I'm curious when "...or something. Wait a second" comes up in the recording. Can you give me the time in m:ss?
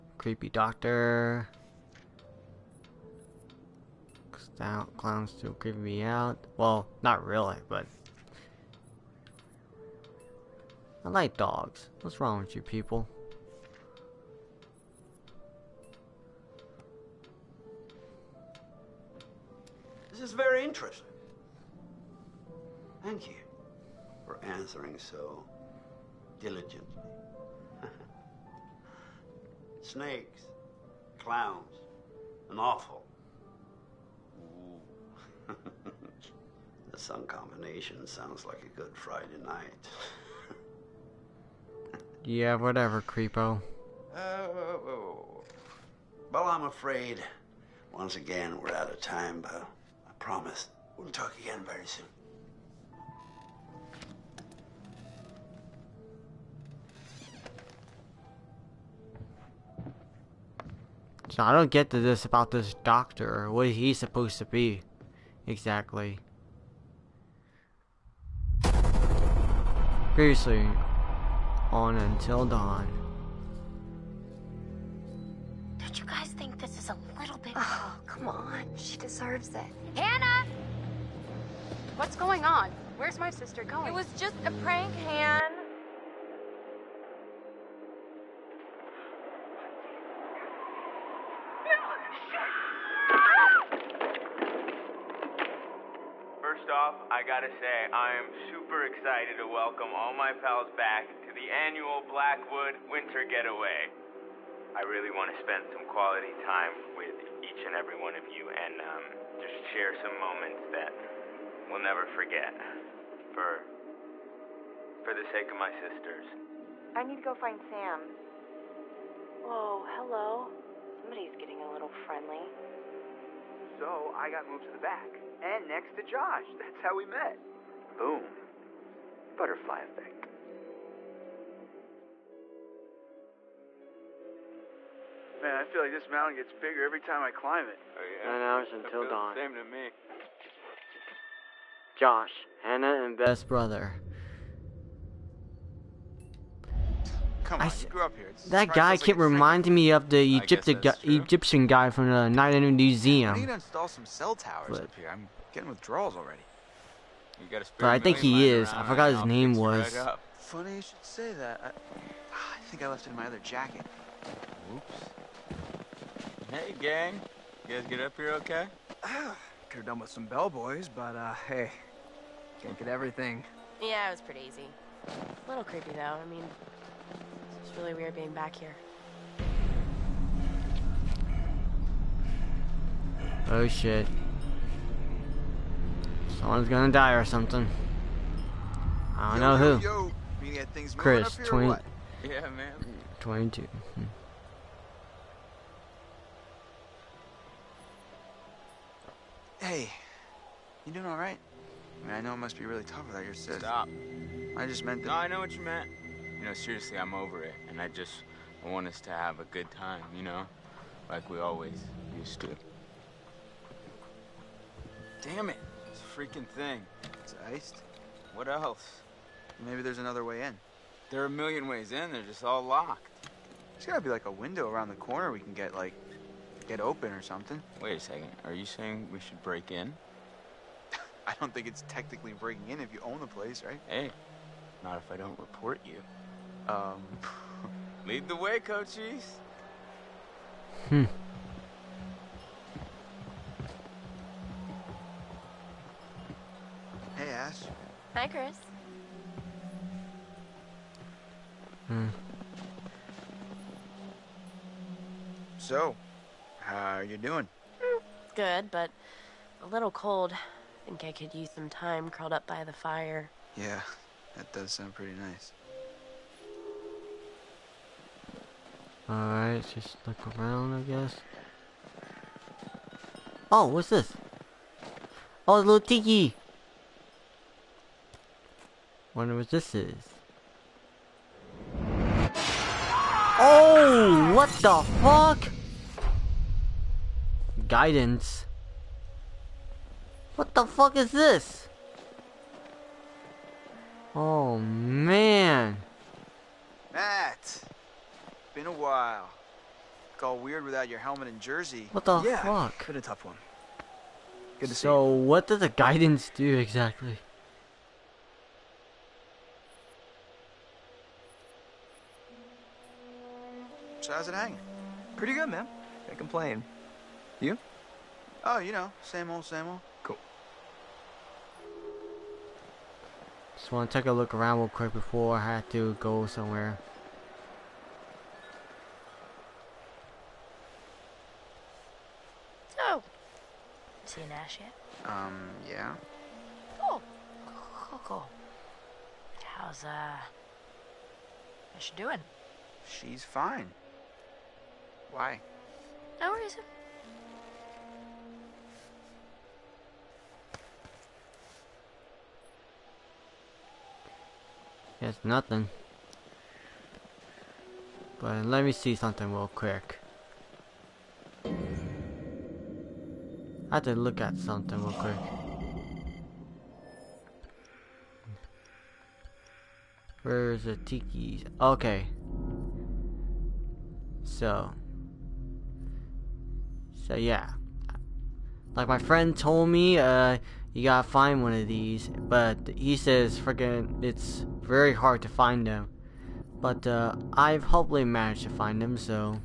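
3:47.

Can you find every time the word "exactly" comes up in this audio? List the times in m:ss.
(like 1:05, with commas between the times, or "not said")
1:05, 5:06.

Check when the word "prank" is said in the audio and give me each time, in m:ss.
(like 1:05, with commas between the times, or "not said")
1:24.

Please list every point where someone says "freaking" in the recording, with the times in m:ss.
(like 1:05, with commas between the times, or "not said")
3:36, 6:23.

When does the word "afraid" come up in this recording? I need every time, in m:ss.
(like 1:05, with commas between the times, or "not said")
0:46.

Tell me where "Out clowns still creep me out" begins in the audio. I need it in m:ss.
0:04.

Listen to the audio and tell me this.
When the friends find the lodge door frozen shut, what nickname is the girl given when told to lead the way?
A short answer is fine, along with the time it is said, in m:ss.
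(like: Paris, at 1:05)
Cochise, at 3:58.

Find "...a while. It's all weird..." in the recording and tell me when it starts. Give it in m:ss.
4:58.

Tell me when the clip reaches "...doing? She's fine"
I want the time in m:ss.
5:41.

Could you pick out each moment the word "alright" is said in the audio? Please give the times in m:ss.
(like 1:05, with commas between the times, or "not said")
3:21, 4:29.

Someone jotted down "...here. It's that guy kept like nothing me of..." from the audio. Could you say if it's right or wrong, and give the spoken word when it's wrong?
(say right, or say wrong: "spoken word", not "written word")
wrong: "reminding", not "nothing".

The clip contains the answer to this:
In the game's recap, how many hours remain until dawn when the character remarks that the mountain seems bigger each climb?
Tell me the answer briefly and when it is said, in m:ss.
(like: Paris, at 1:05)
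9, at 2:18.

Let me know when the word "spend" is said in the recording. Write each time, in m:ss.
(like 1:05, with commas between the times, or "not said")
1:45.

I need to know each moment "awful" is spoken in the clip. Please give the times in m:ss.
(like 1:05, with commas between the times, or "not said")
0:32.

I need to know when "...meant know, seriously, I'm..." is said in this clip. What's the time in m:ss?
3:25.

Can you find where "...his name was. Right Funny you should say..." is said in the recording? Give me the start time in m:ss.
2:39.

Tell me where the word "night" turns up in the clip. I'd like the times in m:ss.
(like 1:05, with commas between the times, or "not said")
0:39, 2:32.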